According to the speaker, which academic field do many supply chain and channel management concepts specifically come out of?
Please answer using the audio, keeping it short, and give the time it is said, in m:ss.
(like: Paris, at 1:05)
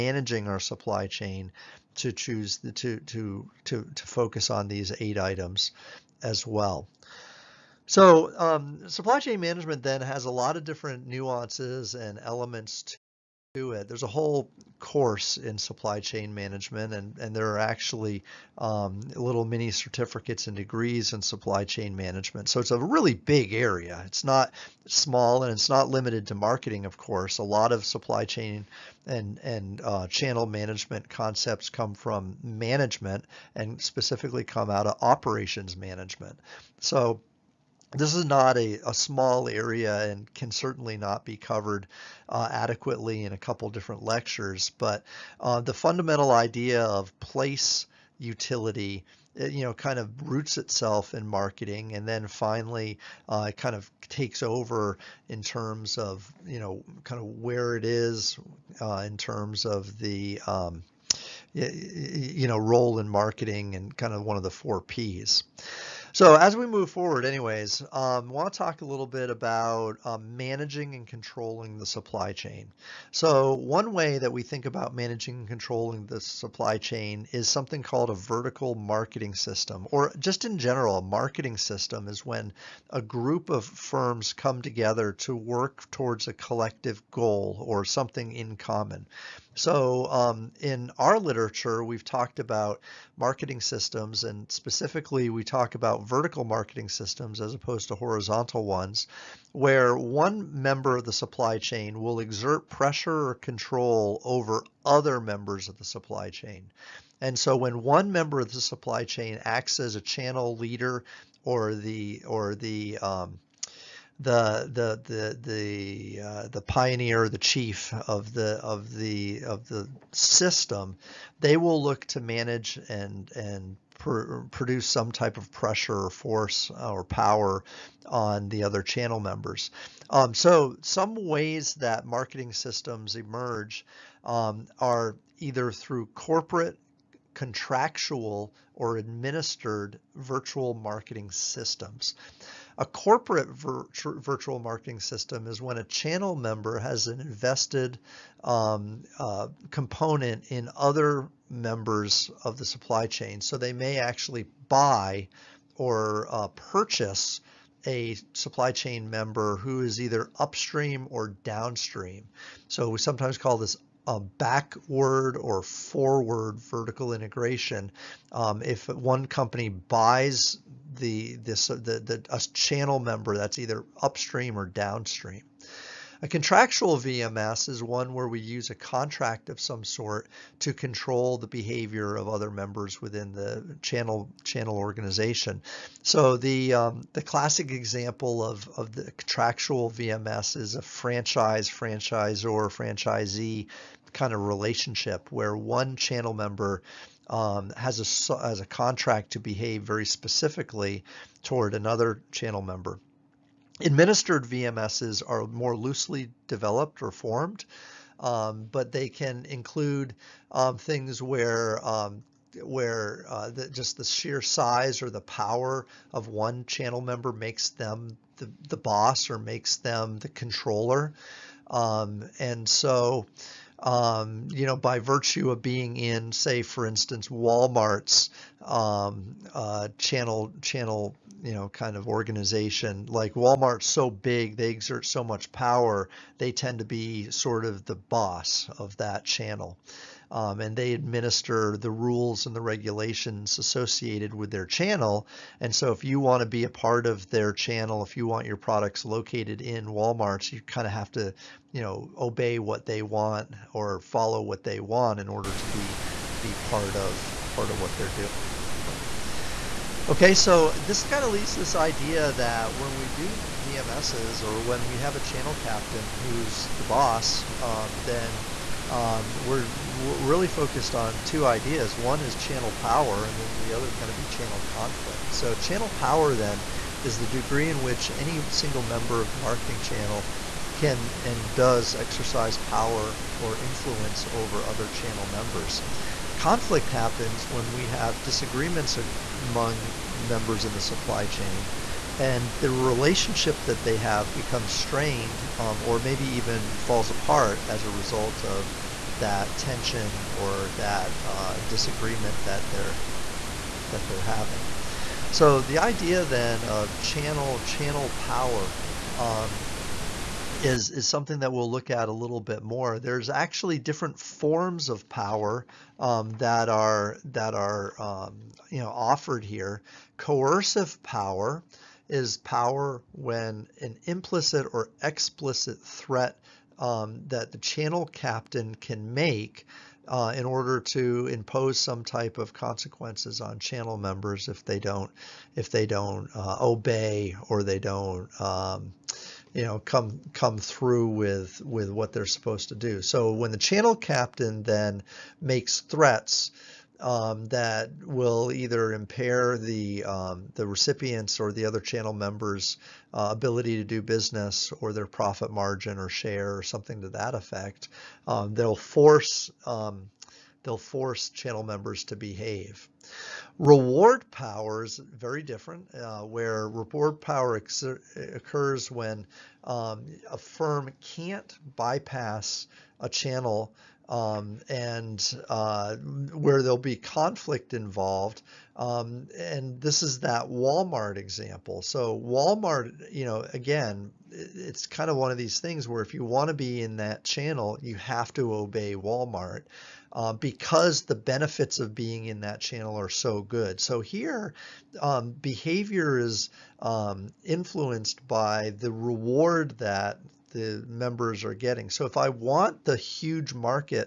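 Operations management, at 0:35.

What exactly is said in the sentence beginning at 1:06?
So as we move forward, anyways, um, want to talk a little bit about um, managing and controlling the supply chain.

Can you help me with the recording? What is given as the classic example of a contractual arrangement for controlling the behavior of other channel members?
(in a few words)
Franchise.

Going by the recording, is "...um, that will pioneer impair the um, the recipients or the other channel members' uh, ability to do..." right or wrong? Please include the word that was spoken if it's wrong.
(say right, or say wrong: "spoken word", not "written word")
wrong: "either", not "pioneer".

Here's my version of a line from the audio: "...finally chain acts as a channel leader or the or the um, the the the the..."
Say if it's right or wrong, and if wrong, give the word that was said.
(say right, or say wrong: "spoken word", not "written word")
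wrong: "supply", not "finally".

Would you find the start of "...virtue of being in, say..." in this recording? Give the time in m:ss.
3:44.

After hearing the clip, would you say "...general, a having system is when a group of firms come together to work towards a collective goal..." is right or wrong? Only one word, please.
wrong.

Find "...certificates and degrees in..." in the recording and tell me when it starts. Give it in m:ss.
0:19.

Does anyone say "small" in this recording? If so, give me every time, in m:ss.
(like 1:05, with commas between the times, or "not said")
0:24, 0:38.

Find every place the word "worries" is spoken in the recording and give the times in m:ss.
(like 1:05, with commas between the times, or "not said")
not said.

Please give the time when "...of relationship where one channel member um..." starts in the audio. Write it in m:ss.
3:14.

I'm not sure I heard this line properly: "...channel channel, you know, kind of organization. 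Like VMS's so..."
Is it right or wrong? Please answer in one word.
wrong.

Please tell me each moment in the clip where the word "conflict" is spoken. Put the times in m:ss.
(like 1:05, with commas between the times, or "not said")
4:34, 4:46, 6:16.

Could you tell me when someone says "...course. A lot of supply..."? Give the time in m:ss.
0:26.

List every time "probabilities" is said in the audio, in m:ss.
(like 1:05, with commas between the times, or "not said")
not said.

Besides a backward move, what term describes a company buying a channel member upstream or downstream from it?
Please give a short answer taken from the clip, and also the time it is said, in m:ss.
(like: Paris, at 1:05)
Forward vertical integration, at 2:45.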